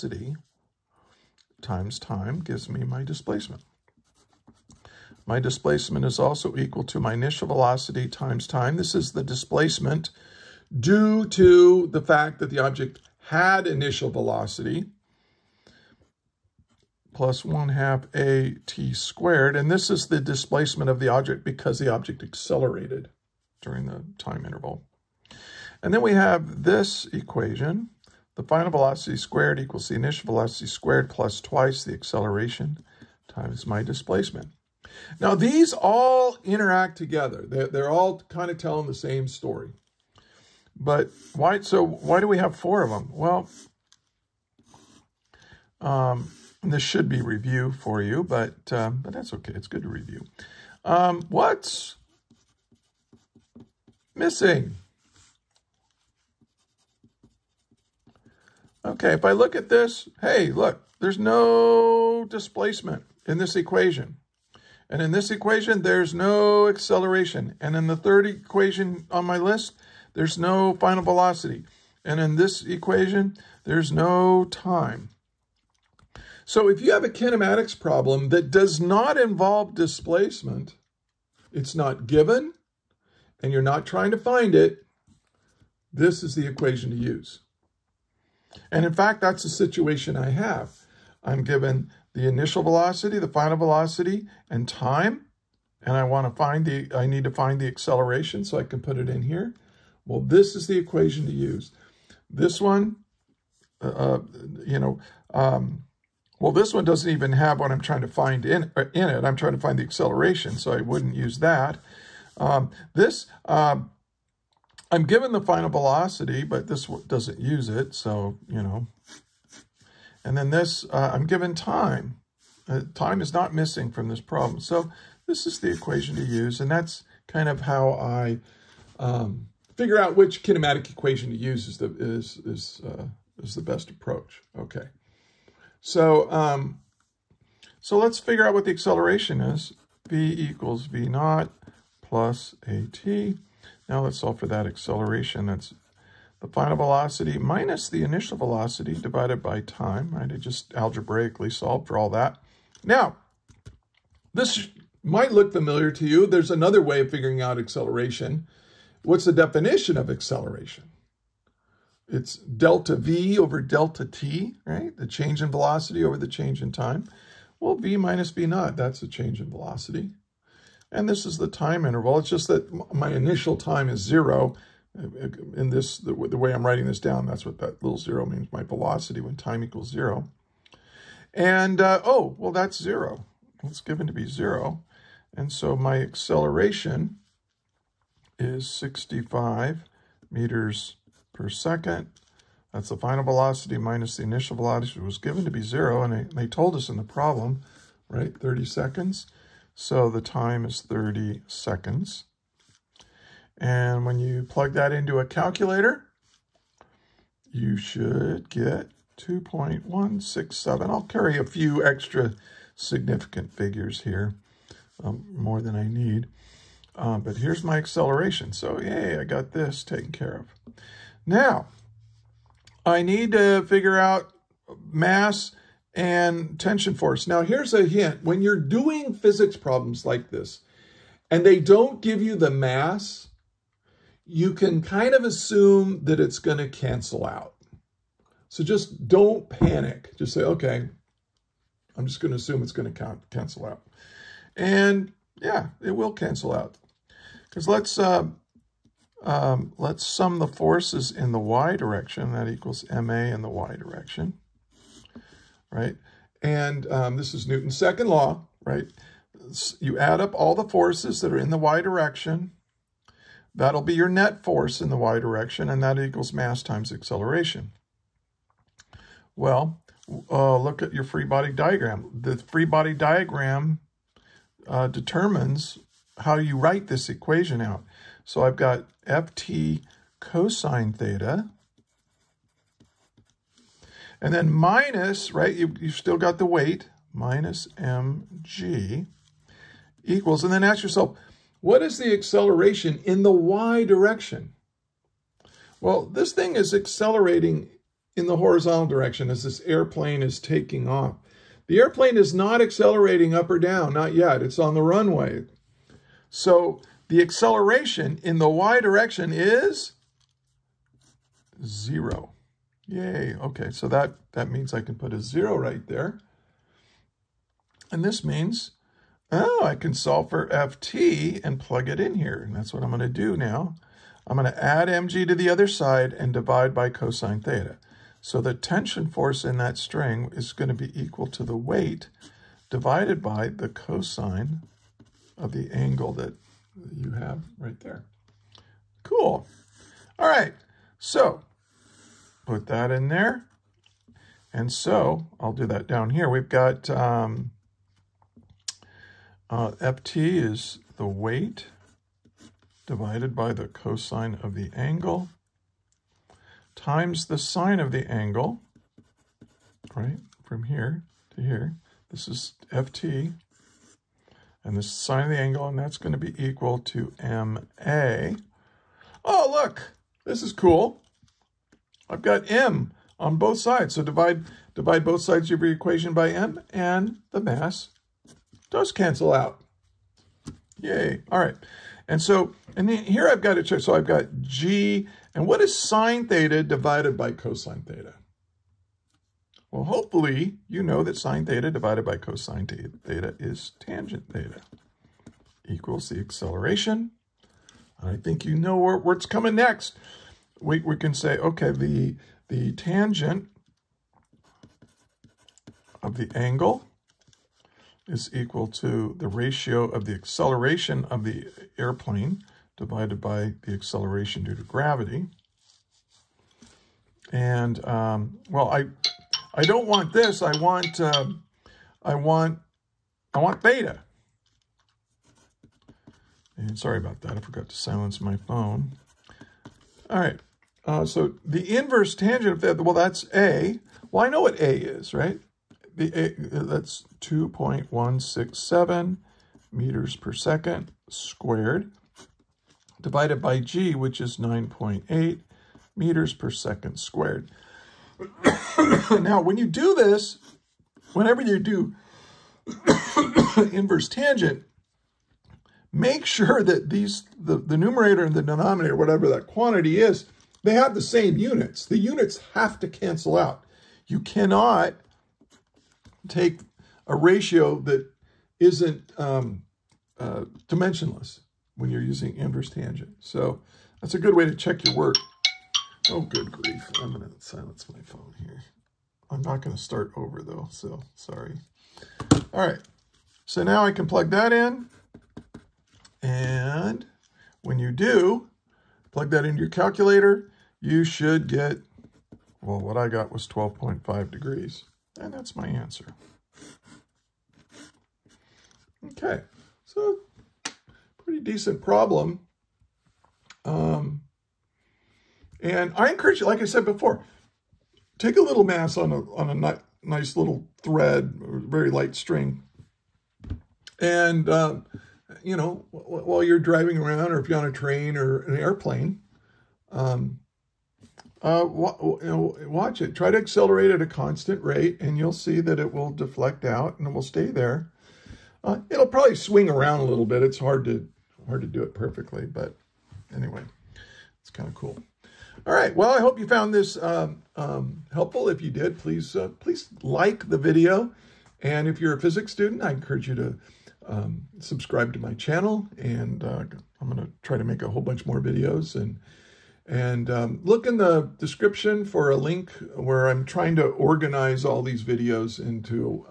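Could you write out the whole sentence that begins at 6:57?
And, um, well, I, I don't want this.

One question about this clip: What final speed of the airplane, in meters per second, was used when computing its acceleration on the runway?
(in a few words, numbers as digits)
65 meters per second.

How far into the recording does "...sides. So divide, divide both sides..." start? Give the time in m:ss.
6:13.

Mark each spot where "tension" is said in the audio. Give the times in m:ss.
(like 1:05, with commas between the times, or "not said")
3:46, 5:28.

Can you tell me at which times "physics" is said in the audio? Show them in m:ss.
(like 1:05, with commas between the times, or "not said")
3:49, 9:02.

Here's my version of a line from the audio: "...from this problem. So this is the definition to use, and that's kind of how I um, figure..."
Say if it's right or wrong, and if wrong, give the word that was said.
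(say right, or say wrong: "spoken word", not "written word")
wrong: "equation", not "definition".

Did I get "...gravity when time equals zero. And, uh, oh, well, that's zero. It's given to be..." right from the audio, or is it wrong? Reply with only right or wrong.
wrong.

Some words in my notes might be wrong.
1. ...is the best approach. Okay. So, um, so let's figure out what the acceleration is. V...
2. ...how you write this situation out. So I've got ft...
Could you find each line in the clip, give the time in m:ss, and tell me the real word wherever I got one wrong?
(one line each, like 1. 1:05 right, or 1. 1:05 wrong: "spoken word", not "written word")
1. 2:13 right
2. 4:36 wrong: "equation", not "situation".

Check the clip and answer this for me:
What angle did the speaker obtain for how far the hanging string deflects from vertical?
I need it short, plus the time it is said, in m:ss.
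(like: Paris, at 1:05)
12.5 degrees, at 8:13.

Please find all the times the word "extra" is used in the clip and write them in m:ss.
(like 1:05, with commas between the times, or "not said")
3:31.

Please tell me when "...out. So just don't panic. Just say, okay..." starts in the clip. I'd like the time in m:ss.
3:57.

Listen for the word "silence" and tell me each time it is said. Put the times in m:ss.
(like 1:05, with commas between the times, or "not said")
7:07, 7:57.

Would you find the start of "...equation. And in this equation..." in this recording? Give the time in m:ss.
1:03.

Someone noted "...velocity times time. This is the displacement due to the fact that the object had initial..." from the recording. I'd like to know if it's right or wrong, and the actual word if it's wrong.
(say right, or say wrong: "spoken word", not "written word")
right.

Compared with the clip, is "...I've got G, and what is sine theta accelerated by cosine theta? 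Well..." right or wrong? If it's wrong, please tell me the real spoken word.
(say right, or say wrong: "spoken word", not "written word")
wrong: "divided", not "accelerated".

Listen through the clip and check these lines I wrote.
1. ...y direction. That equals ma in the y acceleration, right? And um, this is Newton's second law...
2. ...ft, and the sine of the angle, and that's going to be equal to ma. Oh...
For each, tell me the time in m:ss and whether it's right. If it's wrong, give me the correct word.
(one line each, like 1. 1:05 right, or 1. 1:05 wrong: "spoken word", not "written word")
1. 4:11 wrong: "direction", not "acceleration"
2. 6:02 right.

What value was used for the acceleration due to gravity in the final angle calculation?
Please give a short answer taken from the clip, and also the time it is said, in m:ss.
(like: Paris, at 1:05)
9.8 meters per second squared, at 7:24.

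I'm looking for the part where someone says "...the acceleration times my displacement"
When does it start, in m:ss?
0:31.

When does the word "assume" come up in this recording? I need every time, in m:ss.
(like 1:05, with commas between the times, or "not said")
3:55, 4:02.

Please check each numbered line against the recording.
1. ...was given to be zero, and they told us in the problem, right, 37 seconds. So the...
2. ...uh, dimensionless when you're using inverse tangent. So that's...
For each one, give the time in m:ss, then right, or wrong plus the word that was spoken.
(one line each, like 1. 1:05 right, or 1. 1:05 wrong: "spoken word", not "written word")
1. 3:15 wrong: "30", not "37"
2. 7:50 right.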